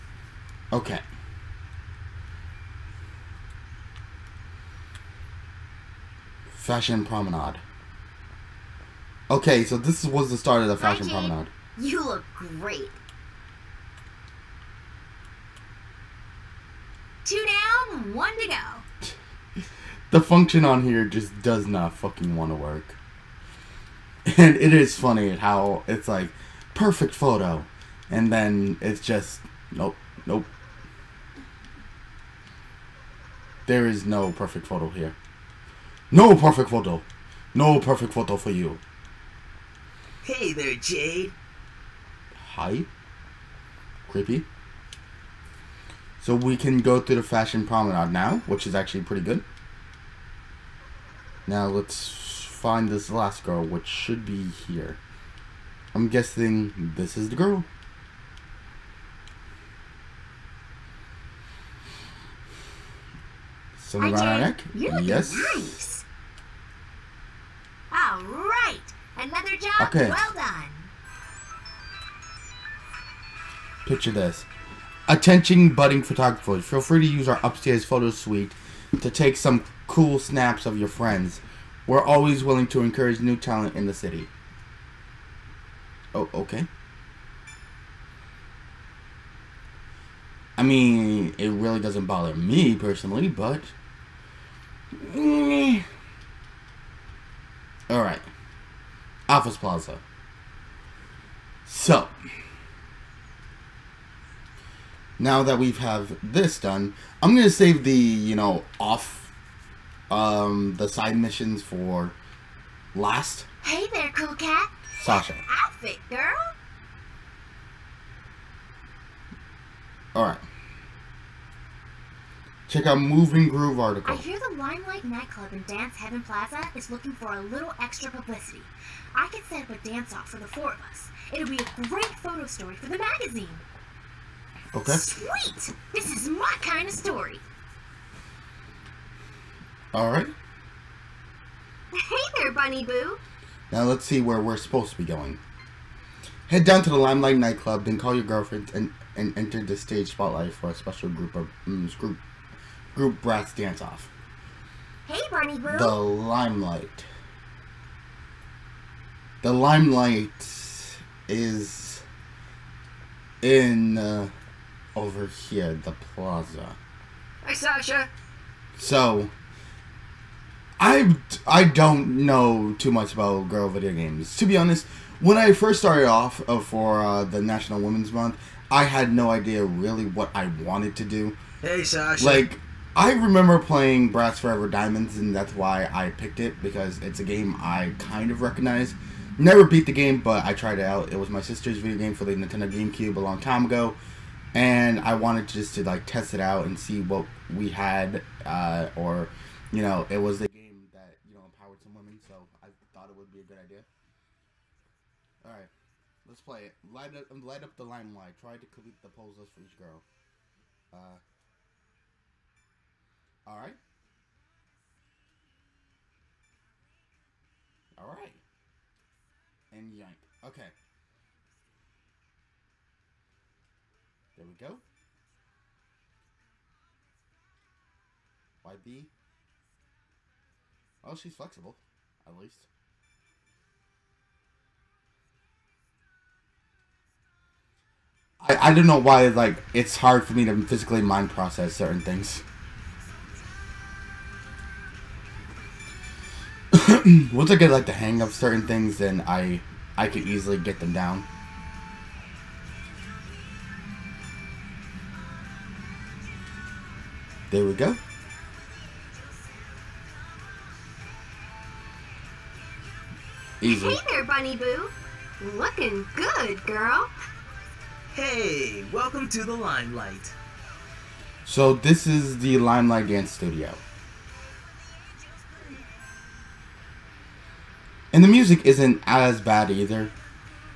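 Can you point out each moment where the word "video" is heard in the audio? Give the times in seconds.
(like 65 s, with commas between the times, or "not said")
173 s, 191 s.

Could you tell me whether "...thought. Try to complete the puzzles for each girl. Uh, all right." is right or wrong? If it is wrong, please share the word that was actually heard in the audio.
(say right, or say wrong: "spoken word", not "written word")
wrong: "limelight", not "thought".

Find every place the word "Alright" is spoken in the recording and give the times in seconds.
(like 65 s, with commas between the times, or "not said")
97 s, 139 s.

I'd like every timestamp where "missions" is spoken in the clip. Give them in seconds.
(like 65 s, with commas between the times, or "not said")
111 s.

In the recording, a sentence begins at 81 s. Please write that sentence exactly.
We're always willing to encourage new talent in the city.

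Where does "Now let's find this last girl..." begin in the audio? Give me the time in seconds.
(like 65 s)
51 s.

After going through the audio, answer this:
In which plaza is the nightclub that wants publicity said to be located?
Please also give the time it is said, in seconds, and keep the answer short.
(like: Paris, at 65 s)
Dance Heaven Plaza, at 125 s.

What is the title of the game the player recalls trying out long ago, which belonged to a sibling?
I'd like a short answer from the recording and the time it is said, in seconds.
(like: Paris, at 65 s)
Bratz Forever Diamondz, at 184 s.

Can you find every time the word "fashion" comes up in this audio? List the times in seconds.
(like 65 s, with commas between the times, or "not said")
6 s, 10 s, 47 s.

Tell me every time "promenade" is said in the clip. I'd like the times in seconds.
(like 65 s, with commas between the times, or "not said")
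7 s, 11 s, 47 s.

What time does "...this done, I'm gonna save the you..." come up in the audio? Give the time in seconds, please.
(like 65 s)
106 s.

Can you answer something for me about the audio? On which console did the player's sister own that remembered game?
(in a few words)
Nintendo GameCube.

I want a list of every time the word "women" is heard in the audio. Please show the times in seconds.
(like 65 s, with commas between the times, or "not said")
177 s, 201 s.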